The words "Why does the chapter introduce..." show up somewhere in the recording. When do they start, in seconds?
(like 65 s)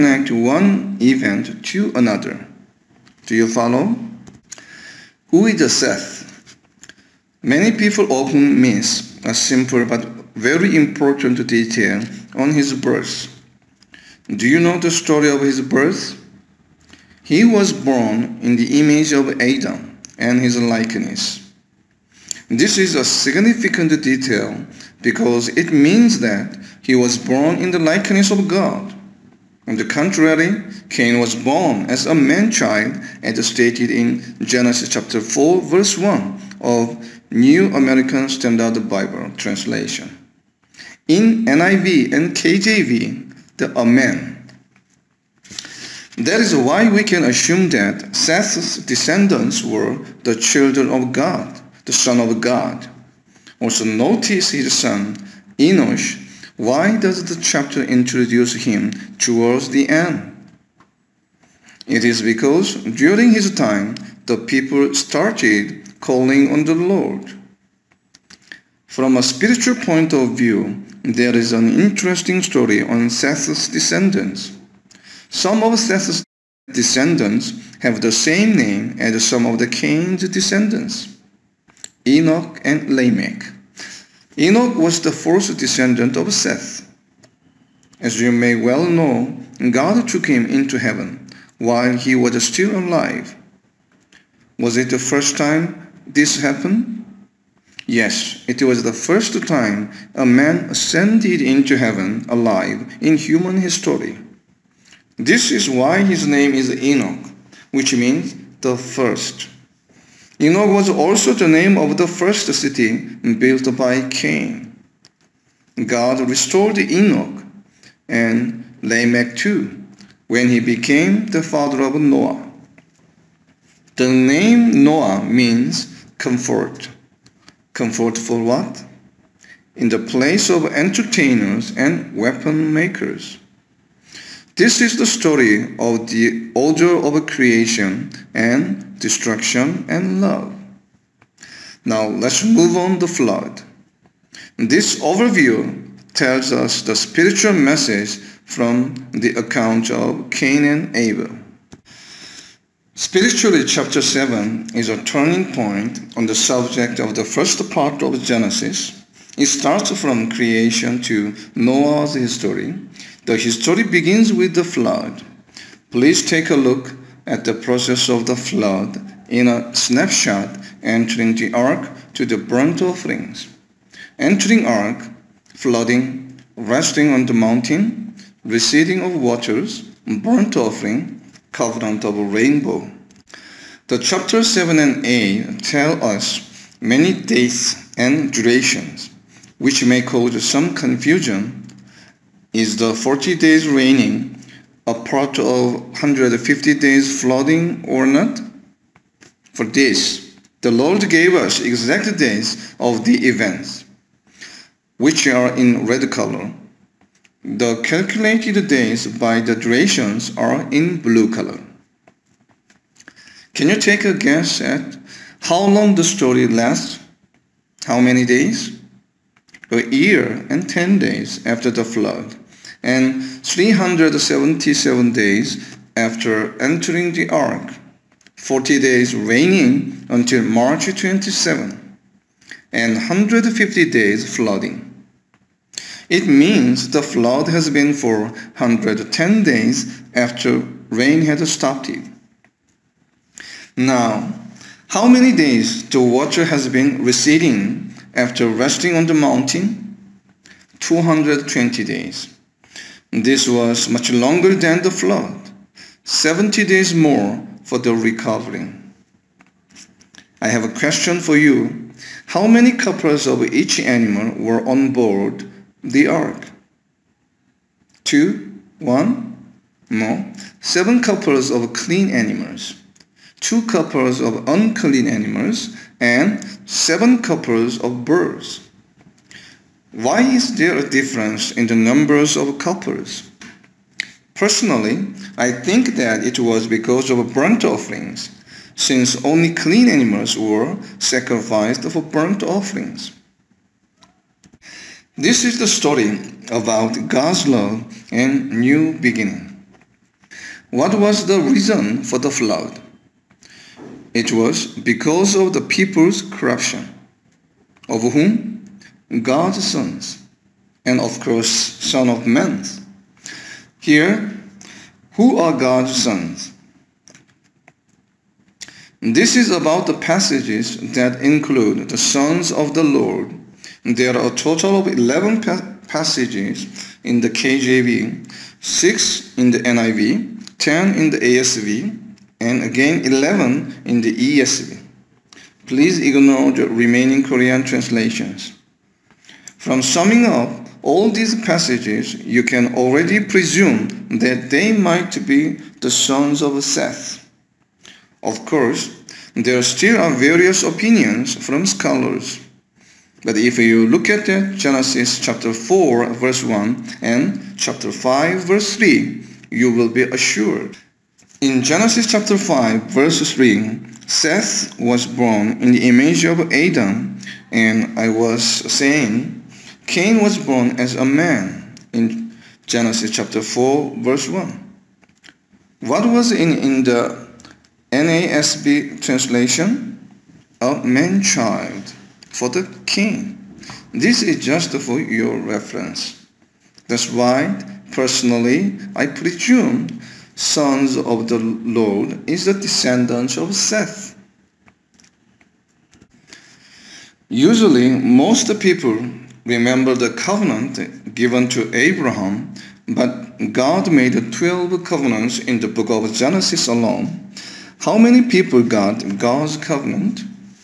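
56 s.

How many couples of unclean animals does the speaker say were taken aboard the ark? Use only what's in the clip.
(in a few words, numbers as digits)
2.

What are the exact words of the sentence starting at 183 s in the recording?
The chapter 7 and 8 tell us many dates and durations, which may cause some confusion.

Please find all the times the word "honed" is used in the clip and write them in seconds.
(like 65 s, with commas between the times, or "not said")
not said.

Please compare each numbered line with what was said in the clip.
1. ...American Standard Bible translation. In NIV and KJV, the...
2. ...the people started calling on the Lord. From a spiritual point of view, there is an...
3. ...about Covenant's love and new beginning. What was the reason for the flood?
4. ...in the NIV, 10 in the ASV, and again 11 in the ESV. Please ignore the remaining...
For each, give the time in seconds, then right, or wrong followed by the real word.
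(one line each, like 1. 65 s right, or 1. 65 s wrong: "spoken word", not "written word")
1. 37 s right
2. 64 s right
3. 296 s wrong: "God", not "Covenant"
4. 329 s right.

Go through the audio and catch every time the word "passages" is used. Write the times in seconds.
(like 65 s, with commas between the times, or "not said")
319 s, 325 s, 341 s.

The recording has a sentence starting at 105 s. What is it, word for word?
This is why his name is Enoch, which means the first.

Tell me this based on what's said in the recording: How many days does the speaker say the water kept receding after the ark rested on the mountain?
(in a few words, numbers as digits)
220.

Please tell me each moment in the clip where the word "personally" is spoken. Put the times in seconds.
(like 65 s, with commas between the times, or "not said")
284 s, 387 s.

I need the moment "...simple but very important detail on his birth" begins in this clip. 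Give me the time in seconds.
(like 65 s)
9 s.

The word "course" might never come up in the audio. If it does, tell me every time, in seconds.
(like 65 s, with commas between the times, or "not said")
311 s, 348 s.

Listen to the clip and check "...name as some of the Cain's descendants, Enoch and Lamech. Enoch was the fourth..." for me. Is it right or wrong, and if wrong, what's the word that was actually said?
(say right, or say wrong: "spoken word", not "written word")
right.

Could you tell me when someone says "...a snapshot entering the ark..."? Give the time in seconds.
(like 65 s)
169 s.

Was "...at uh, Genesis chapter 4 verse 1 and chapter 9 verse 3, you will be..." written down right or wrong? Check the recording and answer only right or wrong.
wrong.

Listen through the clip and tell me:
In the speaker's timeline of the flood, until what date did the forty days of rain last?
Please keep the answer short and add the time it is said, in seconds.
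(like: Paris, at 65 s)
March 27, at 230 s.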